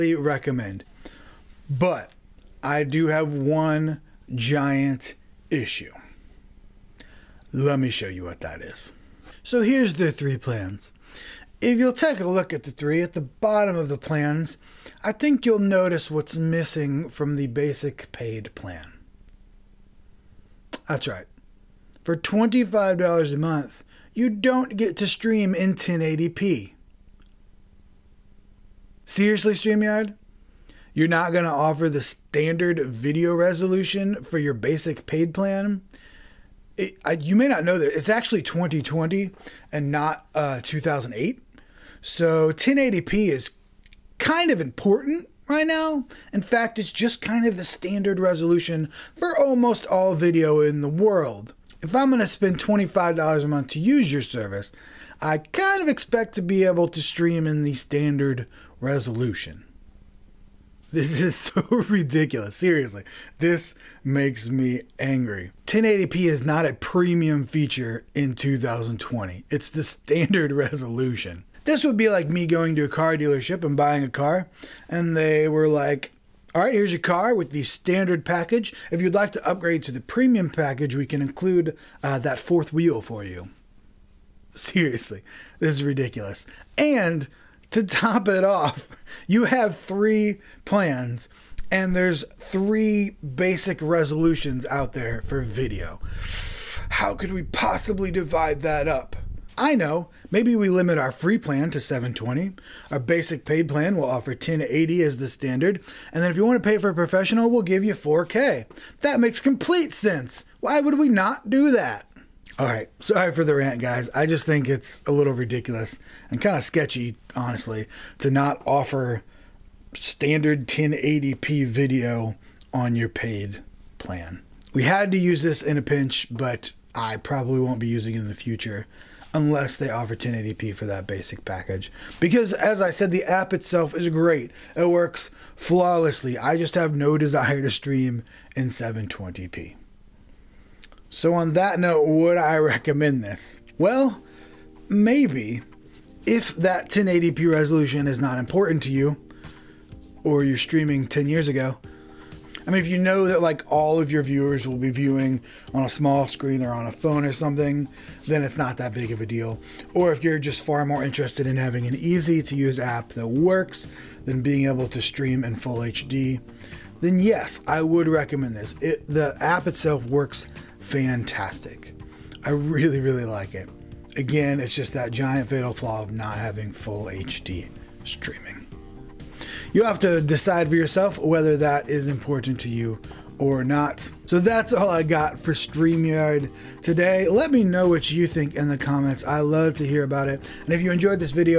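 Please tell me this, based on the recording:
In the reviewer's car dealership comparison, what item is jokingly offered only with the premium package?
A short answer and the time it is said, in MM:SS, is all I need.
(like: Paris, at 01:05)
fourth wheel, at 01:22.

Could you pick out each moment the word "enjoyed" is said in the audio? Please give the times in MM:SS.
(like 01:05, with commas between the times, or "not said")
03:10.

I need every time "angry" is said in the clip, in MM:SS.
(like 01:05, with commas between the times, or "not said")
01:04.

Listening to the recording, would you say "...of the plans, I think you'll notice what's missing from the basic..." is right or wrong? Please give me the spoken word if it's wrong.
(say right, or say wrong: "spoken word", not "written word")
right.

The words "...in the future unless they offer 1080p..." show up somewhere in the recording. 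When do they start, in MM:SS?
02:08.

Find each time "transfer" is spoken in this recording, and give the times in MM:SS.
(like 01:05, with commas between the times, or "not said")
not said.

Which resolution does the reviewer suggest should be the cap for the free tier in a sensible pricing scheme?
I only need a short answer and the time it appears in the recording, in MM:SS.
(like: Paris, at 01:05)
720, at 01:41.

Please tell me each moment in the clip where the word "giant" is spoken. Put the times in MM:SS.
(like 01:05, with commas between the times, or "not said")
00:04, 02:55.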